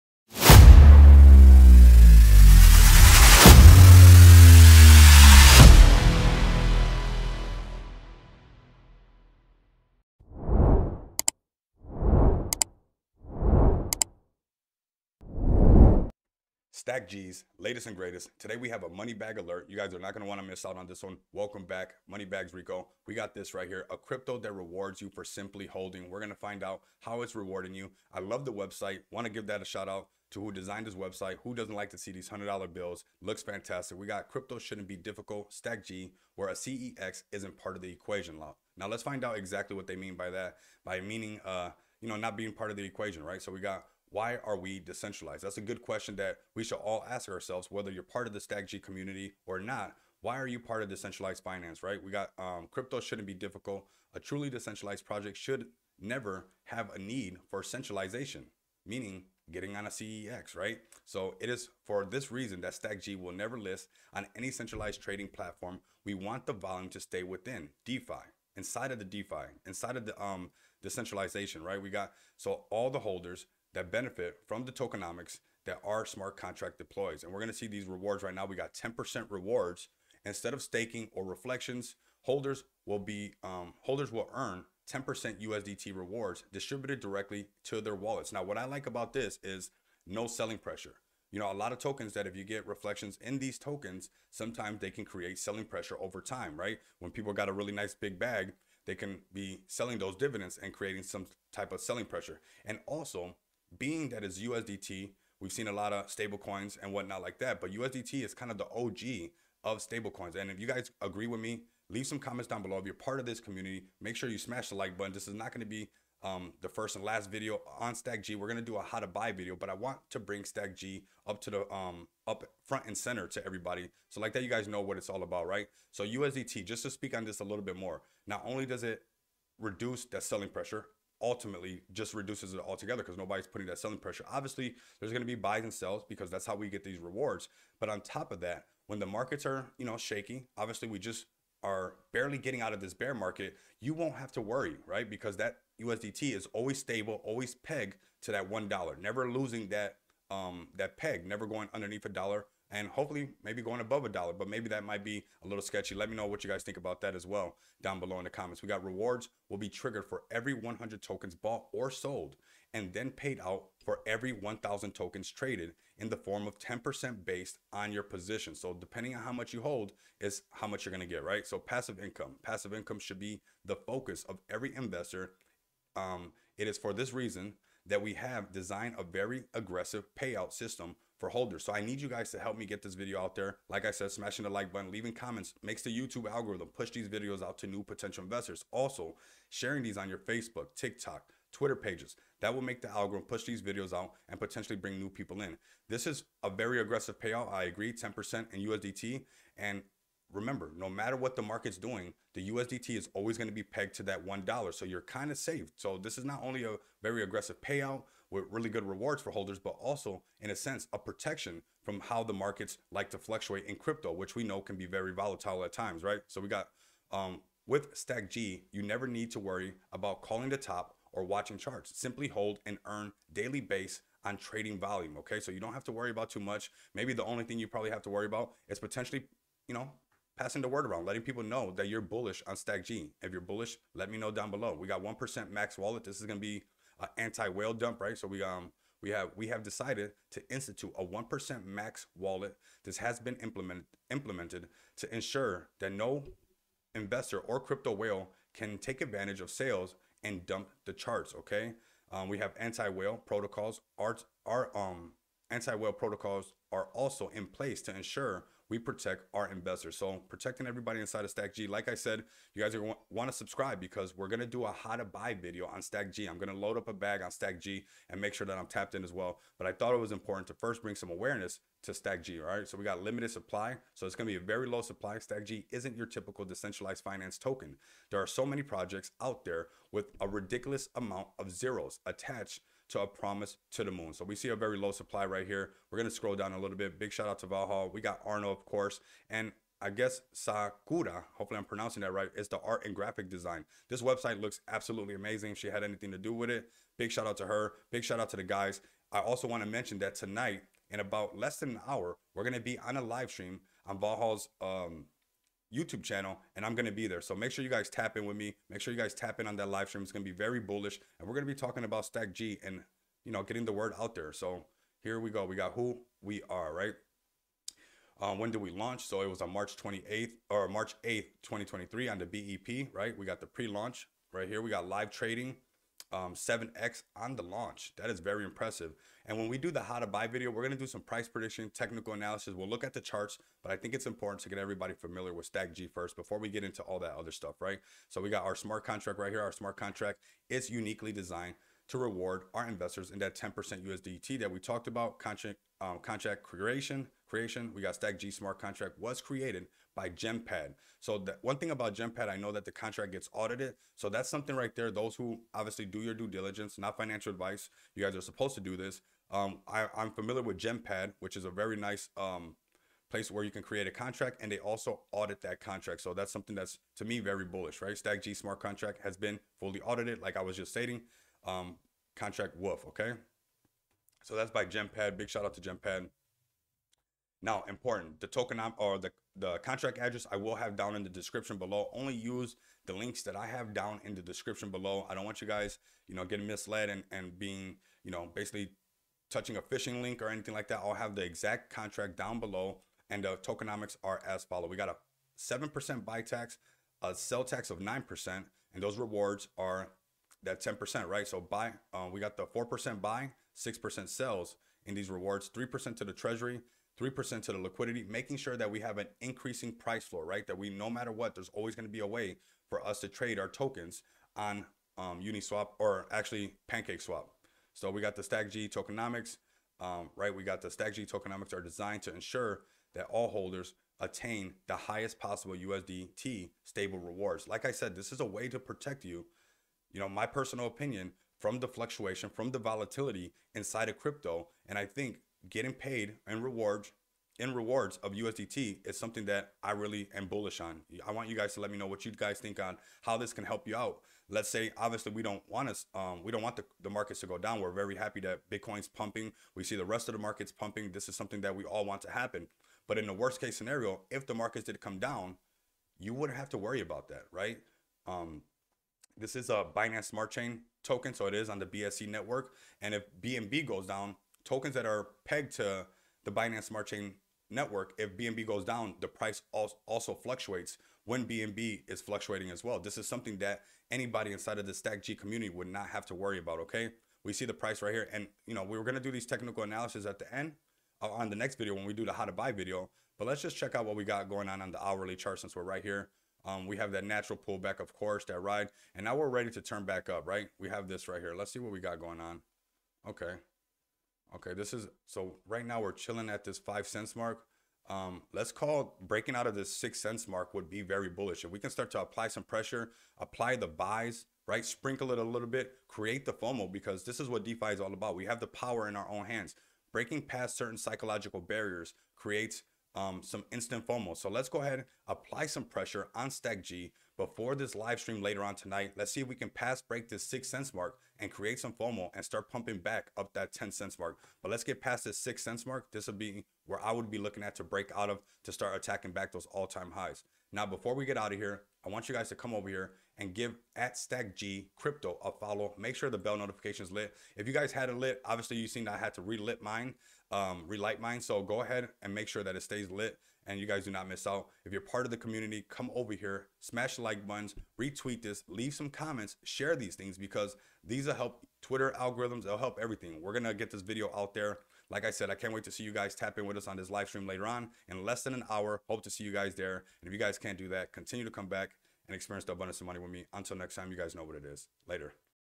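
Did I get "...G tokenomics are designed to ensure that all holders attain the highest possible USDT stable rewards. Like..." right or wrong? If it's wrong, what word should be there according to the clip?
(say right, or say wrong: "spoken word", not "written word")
right.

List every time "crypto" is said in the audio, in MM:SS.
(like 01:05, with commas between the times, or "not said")
00:23, 00:34, 00:52, 03:33, 04:07, 07:13, 08:54.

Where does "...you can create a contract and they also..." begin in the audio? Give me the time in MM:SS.
06:03.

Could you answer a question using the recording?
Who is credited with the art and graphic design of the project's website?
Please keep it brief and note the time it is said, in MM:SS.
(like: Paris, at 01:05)
Sakura, at 04:50.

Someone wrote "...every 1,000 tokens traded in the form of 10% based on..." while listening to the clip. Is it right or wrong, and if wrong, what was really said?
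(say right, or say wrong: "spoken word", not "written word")
right.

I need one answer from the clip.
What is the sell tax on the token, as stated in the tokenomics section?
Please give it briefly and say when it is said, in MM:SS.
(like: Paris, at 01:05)
9%, at 06:37.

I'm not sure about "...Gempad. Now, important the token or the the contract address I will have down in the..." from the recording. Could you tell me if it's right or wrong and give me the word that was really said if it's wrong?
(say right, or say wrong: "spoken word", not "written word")
right.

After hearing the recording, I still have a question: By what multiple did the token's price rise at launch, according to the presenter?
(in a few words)
7x.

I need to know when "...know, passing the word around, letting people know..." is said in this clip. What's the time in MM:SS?
03:49.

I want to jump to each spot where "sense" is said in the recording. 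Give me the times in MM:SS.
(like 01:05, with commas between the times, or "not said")
03:30.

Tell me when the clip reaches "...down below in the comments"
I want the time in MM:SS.
02:37.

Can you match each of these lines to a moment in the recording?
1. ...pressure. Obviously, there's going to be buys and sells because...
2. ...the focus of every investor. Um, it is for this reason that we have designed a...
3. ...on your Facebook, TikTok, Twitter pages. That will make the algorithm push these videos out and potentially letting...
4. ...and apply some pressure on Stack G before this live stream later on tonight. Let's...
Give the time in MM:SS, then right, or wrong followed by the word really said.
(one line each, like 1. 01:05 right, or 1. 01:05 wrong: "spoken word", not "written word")
1. 02:13 right
2. 02:53 right
3. 03:09 wrong: "bring", not "letting"
4. 08:34 right.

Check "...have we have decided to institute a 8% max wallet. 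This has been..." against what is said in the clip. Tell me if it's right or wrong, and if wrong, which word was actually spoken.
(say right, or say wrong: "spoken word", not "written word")
wrong: "1", not "8".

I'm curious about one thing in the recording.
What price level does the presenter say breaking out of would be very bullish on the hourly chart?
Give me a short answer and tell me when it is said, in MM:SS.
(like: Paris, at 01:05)
6 cents, at 08:19.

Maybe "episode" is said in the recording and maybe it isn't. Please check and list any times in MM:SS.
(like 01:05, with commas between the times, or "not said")
not said.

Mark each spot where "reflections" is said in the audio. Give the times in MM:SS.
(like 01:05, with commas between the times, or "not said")
01:21, 01:32.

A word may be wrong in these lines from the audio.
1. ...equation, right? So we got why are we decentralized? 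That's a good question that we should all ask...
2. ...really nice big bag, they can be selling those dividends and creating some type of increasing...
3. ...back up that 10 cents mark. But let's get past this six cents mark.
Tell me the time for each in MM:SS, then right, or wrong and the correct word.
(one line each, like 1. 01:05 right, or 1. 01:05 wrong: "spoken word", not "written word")
1. 00:42 right
2. 01:37 wrong: "selling", not "increasing"
3. 08:42 right.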